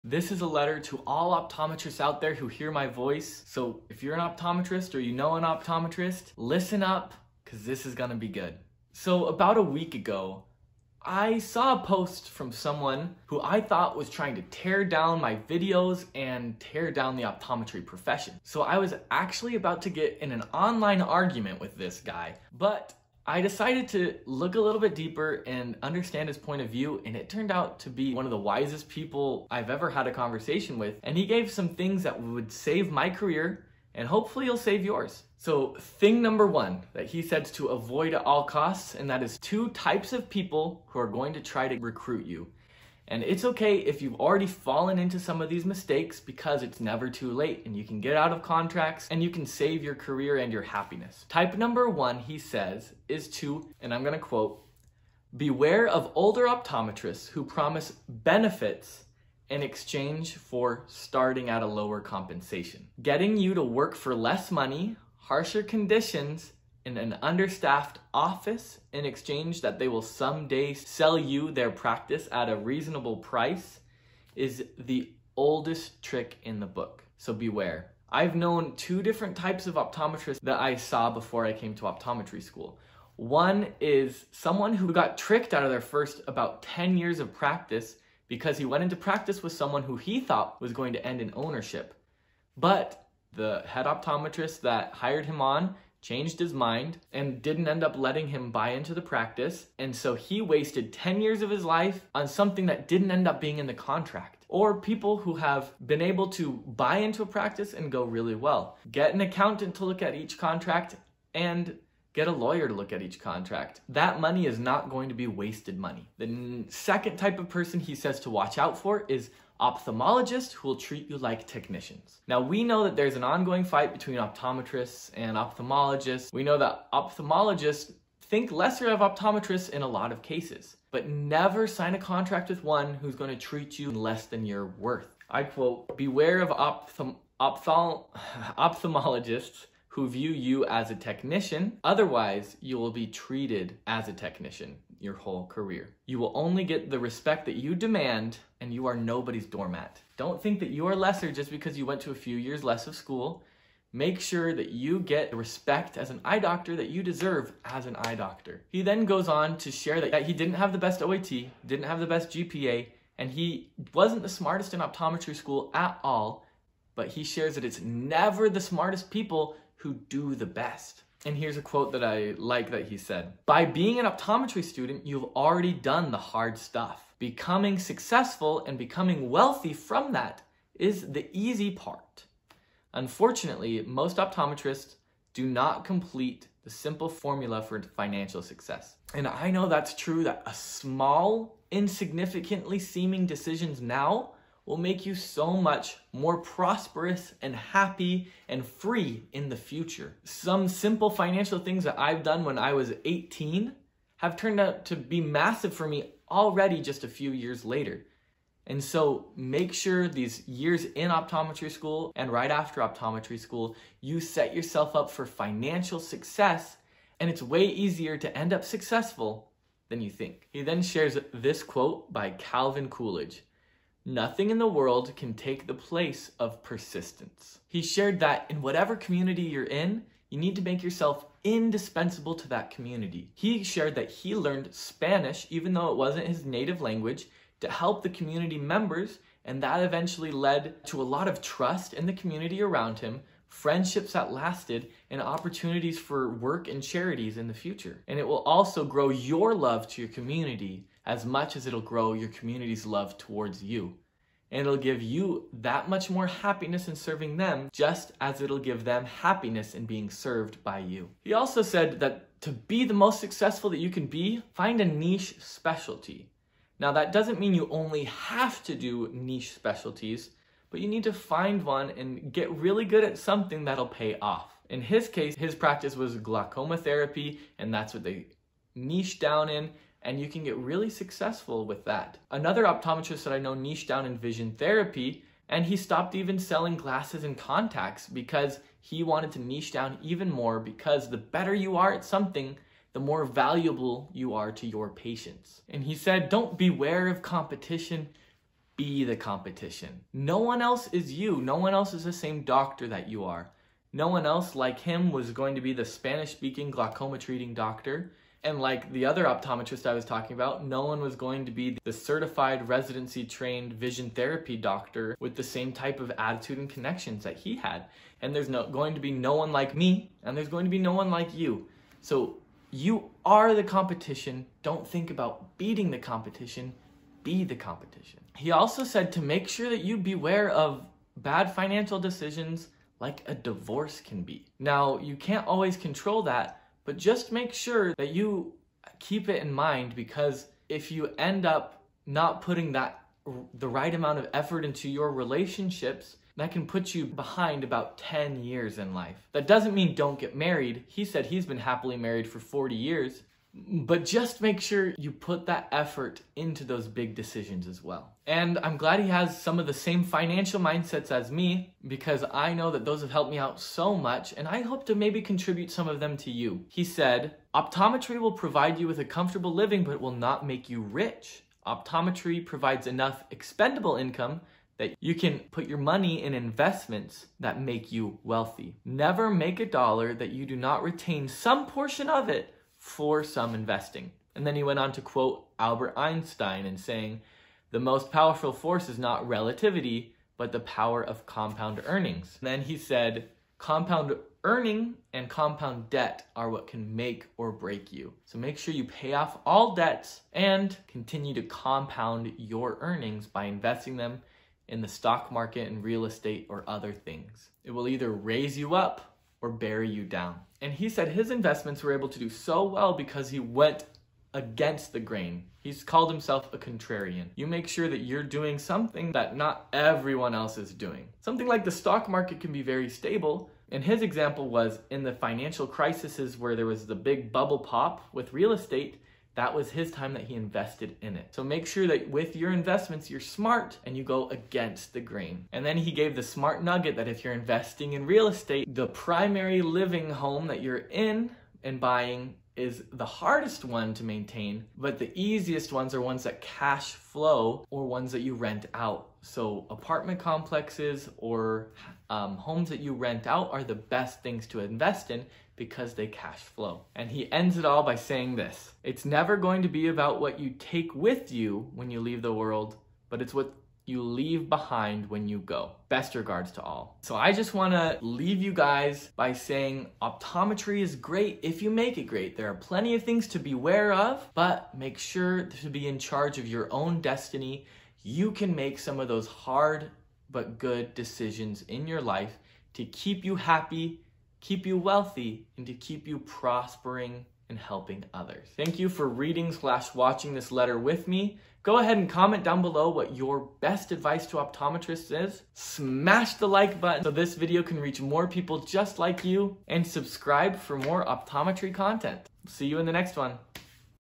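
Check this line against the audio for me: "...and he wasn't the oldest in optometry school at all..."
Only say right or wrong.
wrong.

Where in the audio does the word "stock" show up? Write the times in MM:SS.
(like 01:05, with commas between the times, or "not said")
06:44, 07:01.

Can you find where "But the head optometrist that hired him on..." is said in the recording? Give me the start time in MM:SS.
01:32.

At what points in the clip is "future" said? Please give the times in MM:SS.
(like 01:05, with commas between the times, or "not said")
03:19, 04:07.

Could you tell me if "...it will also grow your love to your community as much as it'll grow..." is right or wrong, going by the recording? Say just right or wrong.
right.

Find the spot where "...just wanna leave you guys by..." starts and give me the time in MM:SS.
07:47.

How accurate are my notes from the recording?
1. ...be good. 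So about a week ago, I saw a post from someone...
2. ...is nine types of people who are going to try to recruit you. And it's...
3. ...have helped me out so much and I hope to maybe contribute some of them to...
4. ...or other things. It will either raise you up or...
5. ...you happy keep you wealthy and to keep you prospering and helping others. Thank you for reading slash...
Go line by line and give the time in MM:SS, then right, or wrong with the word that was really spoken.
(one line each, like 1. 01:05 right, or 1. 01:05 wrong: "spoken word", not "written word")
1. 00:08 right
2. 00:39 wrong: "two", not "nine"
3. 06:03 right
4. 06:46 right
5. 08:03 right.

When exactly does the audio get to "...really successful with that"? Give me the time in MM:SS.
04:40.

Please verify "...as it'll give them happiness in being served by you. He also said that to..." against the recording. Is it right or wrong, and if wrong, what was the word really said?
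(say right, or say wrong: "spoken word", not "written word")
right.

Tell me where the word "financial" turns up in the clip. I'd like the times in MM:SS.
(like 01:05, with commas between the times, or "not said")
03:07, 03:21, 03:35, 05:31, 06:00, 07:05.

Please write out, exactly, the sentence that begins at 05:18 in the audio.
And there's no, going to be no one like me, and there's going to be no one like you.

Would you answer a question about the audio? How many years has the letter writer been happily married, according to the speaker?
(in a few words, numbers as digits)
40.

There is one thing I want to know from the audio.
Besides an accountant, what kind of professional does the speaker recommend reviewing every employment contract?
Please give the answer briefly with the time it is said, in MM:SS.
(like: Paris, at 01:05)
A lawyer, at 01:52.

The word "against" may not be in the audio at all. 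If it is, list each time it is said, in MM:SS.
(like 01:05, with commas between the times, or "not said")
06:54, 07:14.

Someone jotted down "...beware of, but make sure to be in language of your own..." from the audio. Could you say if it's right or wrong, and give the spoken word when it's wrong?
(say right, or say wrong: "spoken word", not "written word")
wrong: "charge", not "language".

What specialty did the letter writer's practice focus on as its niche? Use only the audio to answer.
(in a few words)
Glaucoma therapy.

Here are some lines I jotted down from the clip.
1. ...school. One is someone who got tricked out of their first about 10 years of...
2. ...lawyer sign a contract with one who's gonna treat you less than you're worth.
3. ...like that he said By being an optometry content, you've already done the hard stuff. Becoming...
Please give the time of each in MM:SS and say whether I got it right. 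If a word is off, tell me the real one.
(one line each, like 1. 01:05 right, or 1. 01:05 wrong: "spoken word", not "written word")
1. 01:22 right
2. 02:11 wrong: "never", not "lawyer"
3. 02:52 wrong: "student", not "content".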